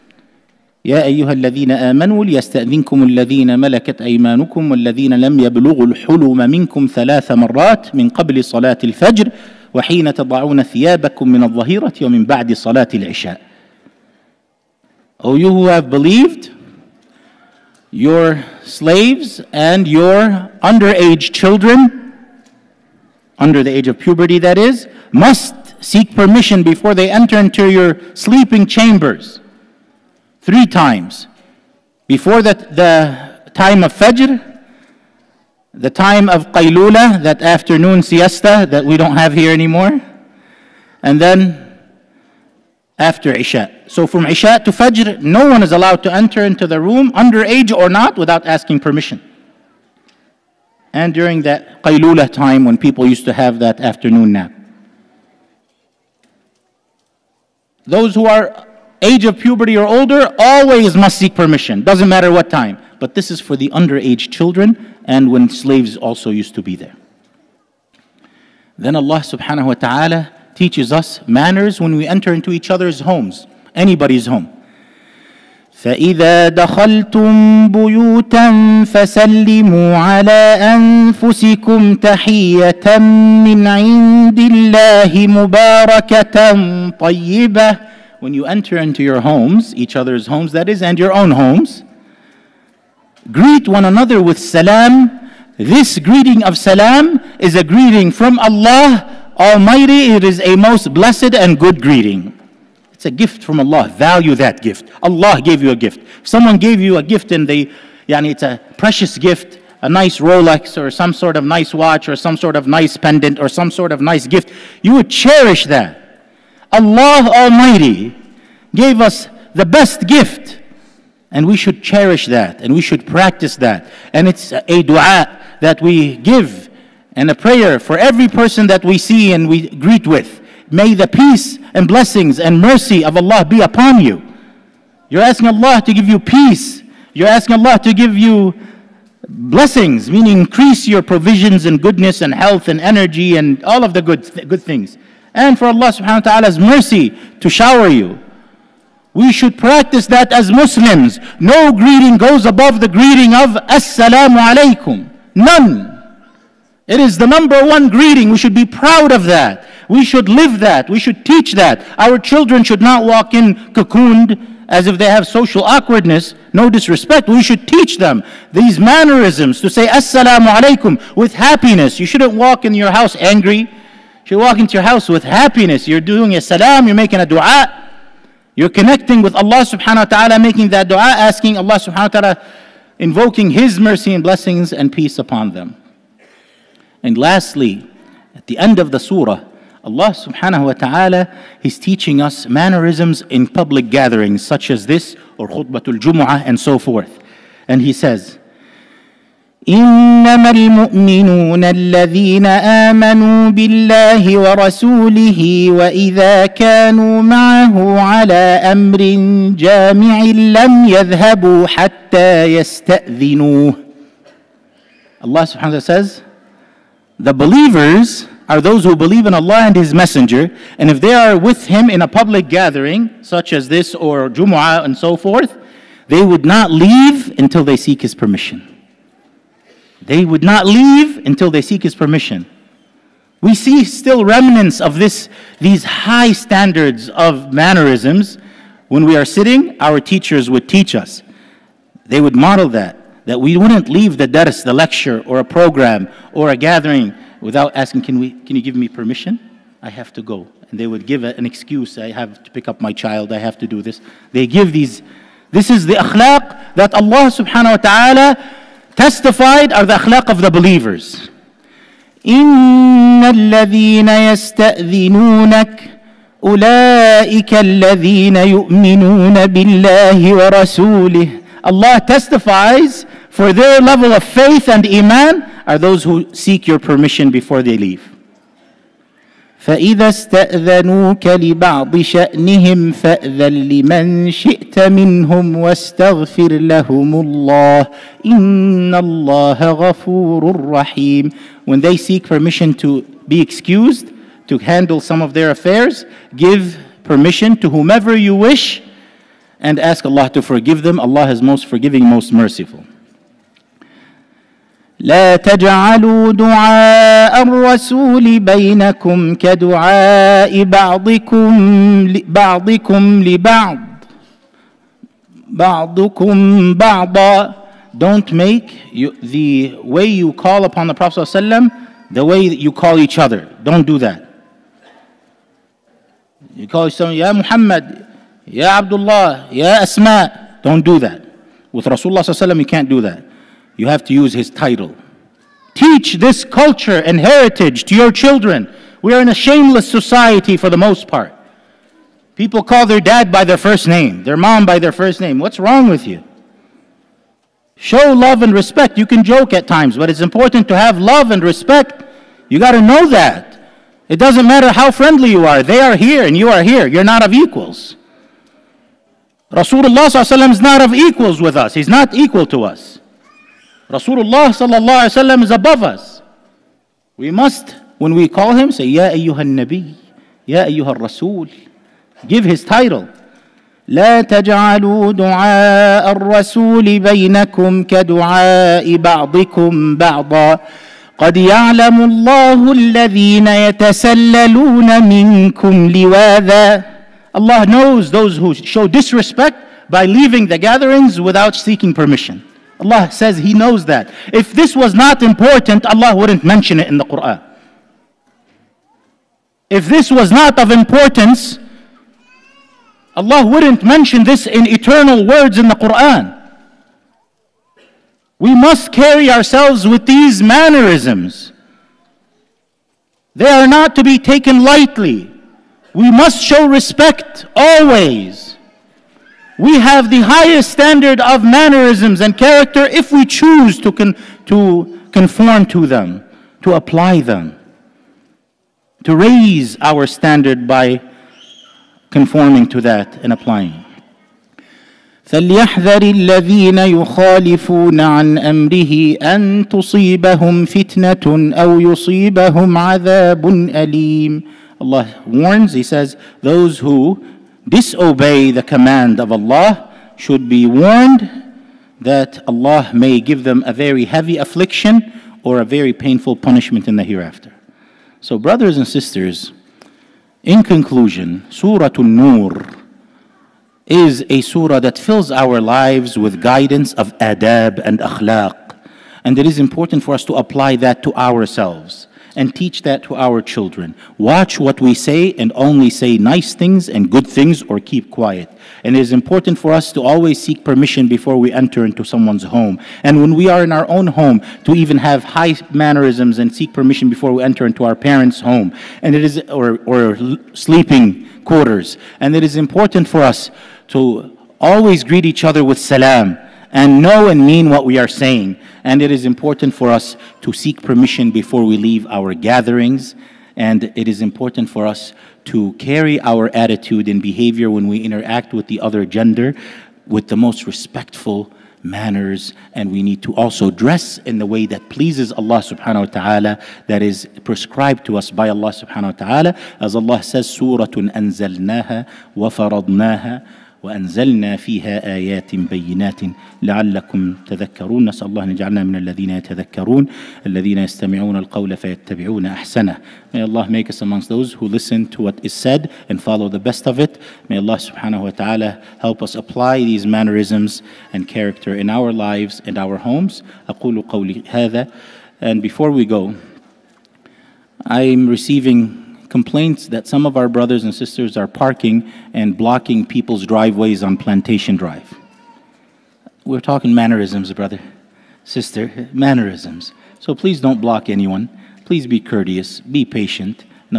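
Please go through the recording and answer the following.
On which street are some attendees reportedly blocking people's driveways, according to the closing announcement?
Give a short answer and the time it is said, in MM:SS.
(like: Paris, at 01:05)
Plantation Drive, at 09:14.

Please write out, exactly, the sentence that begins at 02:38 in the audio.
We should be proud of that.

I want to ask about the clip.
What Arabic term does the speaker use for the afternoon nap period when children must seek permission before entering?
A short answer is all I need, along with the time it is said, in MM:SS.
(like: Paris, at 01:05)
Qa'ilula, at 00:36.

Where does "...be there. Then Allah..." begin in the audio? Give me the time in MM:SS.
01:06.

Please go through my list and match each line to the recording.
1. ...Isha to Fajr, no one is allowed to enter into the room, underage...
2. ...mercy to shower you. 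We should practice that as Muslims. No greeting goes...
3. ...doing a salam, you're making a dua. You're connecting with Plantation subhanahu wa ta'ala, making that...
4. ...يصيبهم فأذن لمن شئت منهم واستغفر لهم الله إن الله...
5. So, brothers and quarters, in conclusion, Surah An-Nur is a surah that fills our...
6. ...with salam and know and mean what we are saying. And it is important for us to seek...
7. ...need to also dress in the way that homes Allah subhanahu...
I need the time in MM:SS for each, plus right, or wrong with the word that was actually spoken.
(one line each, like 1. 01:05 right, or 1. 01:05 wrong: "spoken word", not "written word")
1. 00:44 right
2. 02:26 right
3. 02:56 wrong: "Allah", not "Plantation"
4. 04:42 wrong: "شأنهم", not "يصيبهم"
5. 07:38 wrong: "sisters", not "quarters"
6. 08:15 right
7. 08:33 wrong: "pleases", not "homes".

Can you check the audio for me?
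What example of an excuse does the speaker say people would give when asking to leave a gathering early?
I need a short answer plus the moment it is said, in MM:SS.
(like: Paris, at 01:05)
pick up my child, at 04:12.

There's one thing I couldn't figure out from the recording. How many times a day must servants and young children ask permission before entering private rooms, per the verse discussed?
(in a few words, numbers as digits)
3.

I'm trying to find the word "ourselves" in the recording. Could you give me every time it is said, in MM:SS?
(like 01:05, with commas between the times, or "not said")
06:49, 07:51.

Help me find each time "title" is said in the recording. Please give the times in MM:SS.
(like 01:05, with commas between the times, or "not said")
05:34, 06:12.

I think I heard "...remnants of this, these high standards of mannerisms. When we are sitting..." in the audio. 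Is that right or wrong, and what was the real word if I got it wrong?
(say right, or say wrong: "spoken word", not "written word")
right.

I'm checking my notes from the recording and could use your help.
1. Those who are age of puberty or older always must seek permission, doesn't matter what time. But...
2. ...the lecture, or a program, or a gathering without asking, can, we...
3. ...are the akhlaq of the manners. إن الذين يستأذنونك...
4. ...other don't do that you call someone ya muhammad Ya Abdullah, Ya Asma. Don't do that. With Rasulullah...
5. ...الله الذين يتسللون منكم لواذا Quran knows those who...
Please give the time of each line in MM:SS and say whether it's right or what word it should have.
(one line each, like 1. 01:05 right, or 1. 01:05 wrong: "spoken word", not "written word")
1. 00:57 right
2. 04:04 right
3. 04:19 wrong: "believers", not "manners"
4. 05:23 right
5. 06:22 wrong: "Allah", not "Quran".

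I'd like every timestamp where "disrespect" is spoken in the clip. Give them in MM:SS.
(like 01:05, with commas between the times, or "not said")
02:46, 06:28.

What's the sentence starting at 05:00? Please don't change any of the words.
Allah is most forgiving, most merciful.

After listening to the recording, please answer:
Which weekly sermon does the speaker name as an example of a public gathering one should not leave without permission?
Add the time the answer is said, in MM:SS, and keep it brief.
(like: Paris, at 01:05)
khutbatul jumu'ah, at 03:15.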